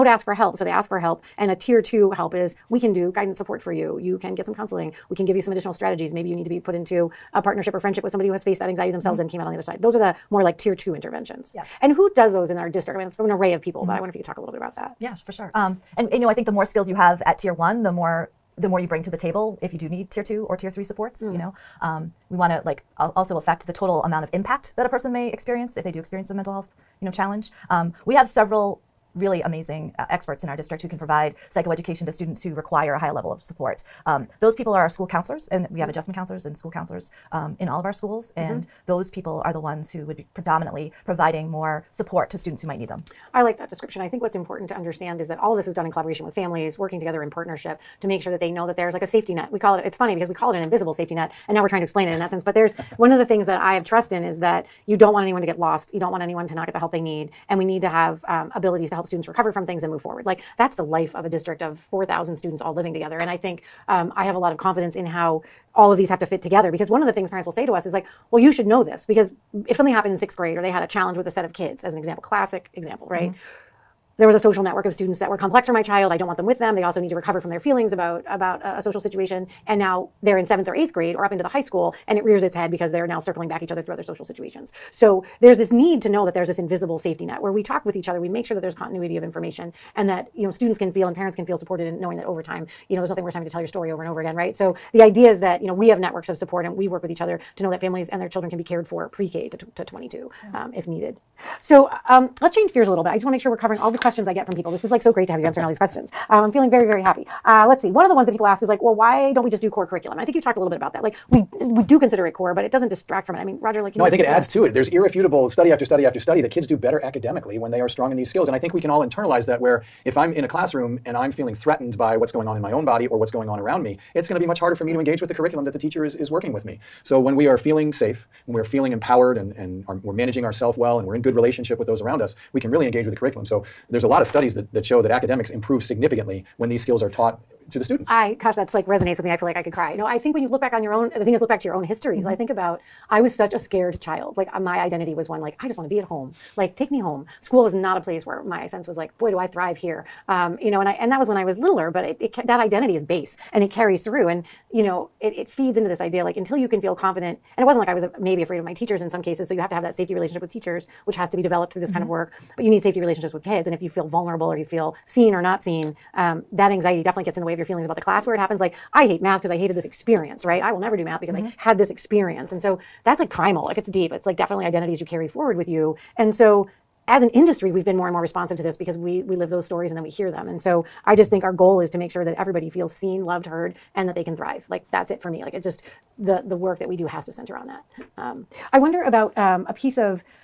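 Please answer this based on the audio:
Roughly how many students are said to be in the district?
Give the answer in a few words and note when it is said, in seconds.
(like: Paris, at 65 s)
4,000, at 61 s.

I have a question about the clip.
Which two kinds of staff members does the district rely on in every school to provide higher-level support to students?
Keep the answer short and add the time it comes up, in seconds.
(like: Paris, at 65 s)
Adjustment counselors and school counselors, at 35 s.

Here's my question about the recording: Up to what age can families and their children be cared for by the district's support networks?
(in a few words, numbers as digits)
22.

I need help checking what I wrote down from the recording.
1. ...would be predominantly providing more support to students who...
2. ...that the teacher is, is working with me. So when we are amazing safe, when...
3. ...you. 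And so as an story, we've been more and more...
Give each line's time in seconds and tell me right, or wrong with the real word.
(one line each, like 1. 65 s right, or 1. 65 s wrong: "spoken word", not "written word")
1. 40 s right
2. 125 s wrong: "feeling", not "amazing"
3. 175 s wrong: "industry", not "story".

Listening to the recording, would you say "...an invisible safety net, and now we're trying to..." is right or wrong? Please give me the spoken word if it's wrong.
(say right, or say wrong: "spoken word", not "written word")
right.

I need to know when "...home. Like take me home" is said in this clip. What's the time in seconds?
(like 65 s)
146 s.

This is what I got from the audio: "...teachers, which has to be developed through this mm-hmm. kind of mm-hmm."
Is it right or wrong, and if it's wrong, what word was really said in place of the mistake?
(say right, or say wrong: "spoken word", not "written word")
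right.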